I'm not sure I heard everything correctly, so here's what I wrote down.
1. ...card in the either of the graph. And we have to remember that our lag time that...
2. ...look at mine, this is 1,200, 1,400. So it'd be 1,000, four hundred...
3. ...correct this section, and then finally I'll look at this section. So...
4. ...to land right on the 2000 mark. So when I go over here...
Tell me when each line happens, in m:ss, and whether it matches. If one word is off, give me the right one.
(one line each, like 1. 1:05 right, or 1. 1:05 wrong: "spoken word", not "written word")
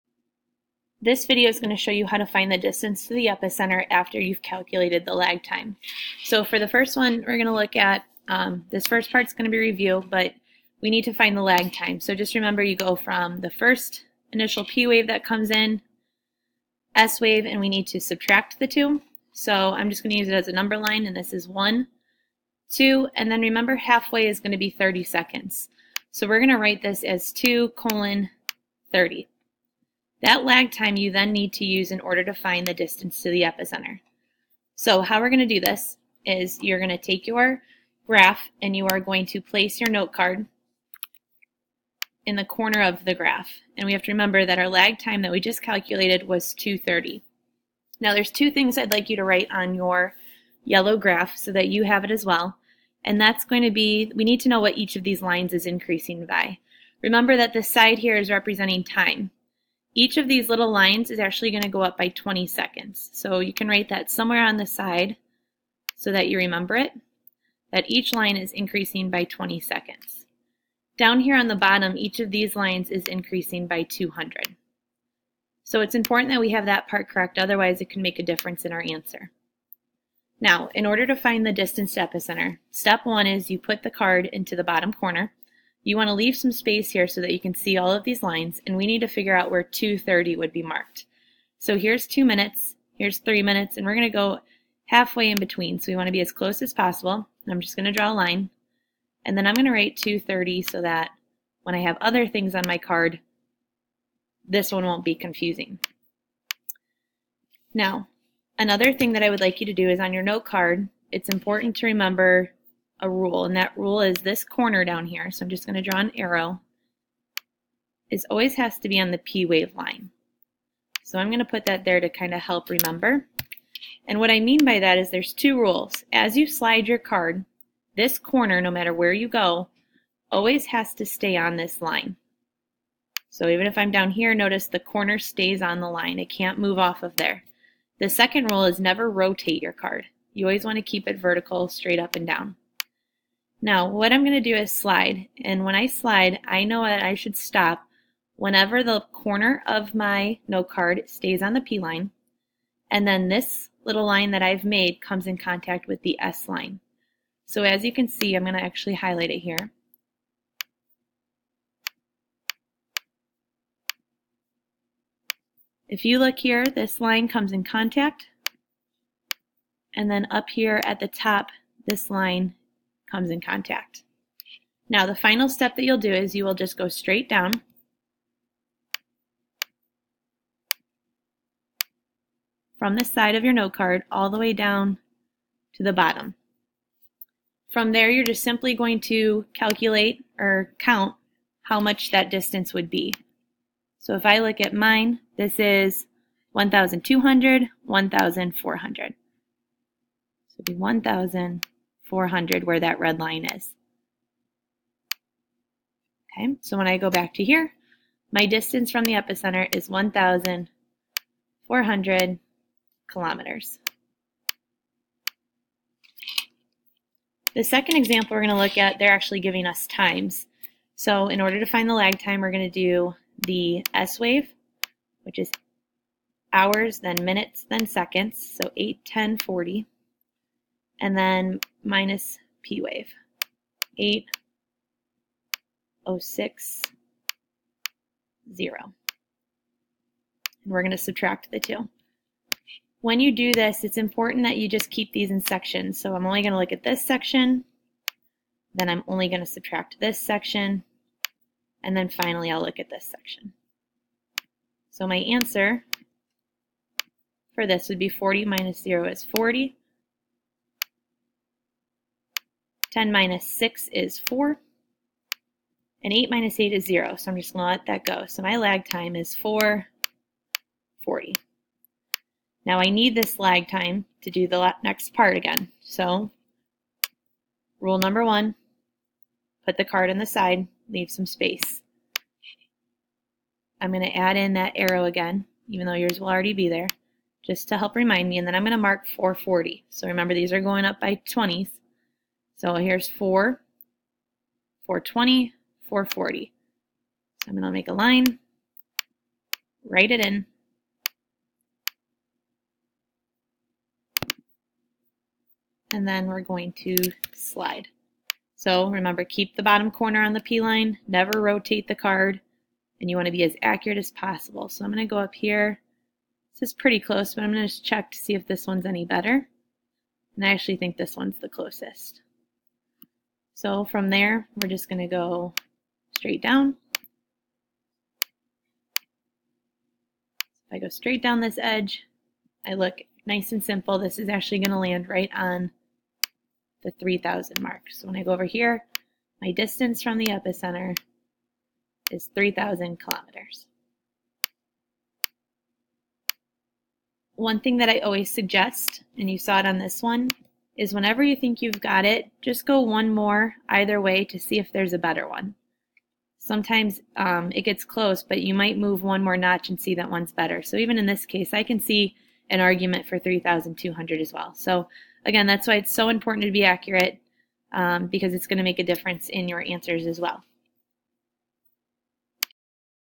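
1. 0:40 wrong: "corner", not "either"
2. 3:14 right
3. 4:09 wrong: "subtract", not "correct"
4. 5:34 wrong: "3000", not "2000".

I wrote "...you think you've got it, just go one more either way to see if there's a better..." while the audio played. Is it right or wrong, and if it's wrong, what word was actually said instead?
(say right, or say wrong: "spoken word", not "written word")
right.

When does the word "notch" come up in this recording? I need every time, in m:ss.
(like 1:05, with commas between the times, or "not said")
5:59.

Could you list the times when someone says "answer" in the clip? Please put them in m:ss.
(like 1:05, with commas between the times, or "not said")
1:18, 4:15, 6:09.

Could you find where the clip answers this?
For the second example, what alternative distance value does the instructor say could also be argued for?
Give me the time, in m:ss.
6:03.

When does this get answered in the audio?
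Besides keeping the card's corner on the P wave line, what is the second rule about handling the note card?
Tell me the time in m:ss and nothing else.
2:18.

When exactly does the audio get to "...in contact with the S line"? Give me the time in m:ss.
2:35.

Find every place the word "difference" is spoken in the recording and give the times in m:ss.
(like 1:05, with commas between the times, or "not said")
1:18, 6:08.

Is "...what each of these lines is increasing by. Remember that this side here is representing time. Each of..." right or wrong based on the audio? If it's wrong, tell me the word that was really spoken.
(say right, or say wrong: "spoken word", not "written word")
right.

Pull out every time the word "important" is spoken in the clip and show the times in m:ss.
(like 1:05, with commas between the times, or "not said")
1:15, 1:51, 4:03, 6:06.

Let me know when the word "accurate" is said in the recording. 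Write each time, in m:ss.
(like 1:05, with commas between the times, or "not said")
5:13, 6:06.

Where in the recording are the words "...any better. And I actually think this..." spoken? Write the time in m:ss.
5:18.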